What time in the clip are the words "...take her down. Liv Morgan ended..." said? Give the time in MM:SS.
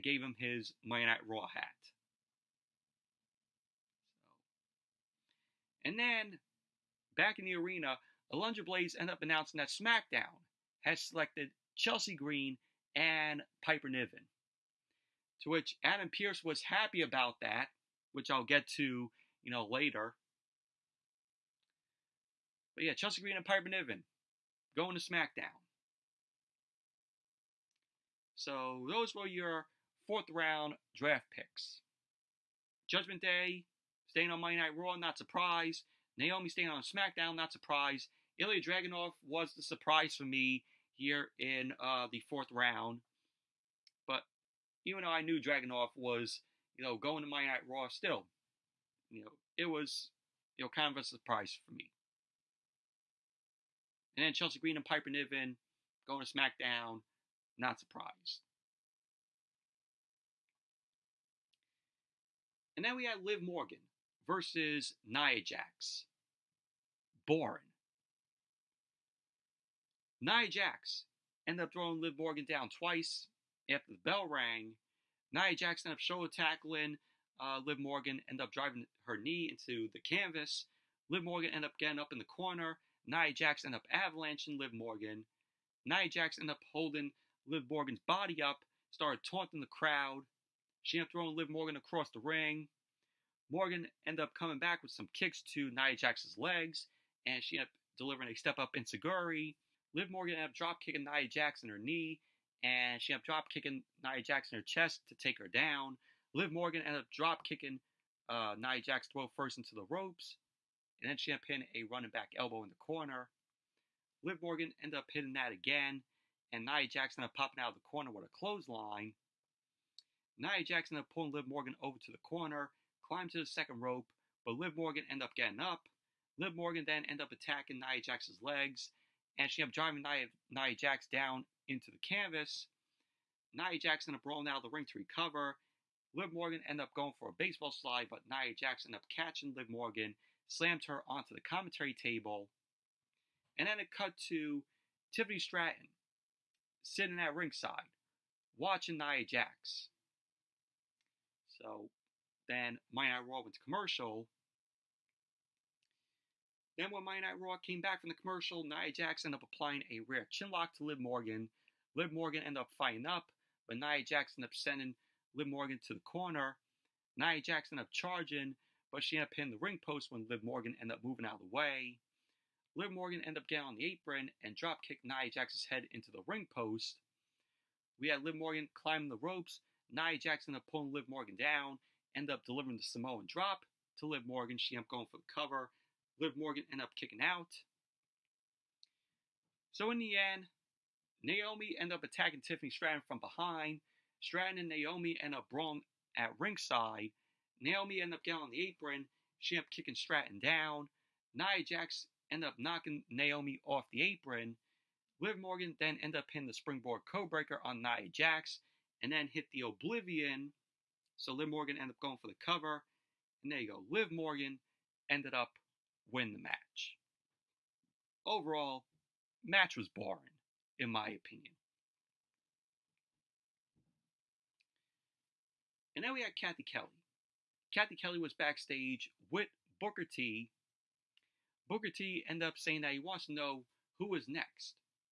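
01:45.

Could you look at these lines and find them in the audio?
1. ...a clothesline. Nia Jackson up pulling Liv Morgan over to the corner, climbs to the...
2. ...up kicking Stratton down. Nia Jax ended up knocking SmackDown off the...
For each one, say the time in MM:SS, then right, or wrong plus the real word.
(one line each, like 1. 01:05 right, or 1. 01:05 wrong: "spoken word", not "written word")
1. 01:58 right
2. 03:19 wrong: "Naomi", not "SmackDown".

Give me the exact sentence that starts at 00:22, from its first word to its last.
But yeah, Chelsea Green and Piper Niven going to SmackDown.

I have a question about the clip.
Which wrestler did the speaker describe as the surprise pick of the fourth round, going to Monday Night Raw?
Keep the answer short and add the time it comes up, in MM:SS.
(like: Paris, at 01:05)
Ilya Dragunov, at 00:38.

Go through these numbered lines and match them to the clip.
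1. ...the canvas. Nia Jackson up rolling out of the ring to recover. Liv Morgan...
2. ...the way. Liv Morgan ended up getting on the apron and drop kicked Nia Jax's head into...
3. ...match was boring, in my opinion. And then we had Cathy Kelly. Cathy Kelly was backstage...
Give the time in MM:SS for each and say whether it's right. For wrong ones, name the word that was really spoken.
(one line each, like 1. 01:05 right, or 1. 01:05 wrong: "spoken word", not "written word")
1. 02:11 right
2. 02:51 right
3. 03:39 right.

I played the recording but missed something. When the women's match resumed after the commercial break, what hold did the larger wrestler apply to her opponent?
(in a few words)
chinlock.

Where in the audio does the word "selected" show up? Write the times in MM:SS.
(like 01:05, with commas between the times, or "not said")
00:10.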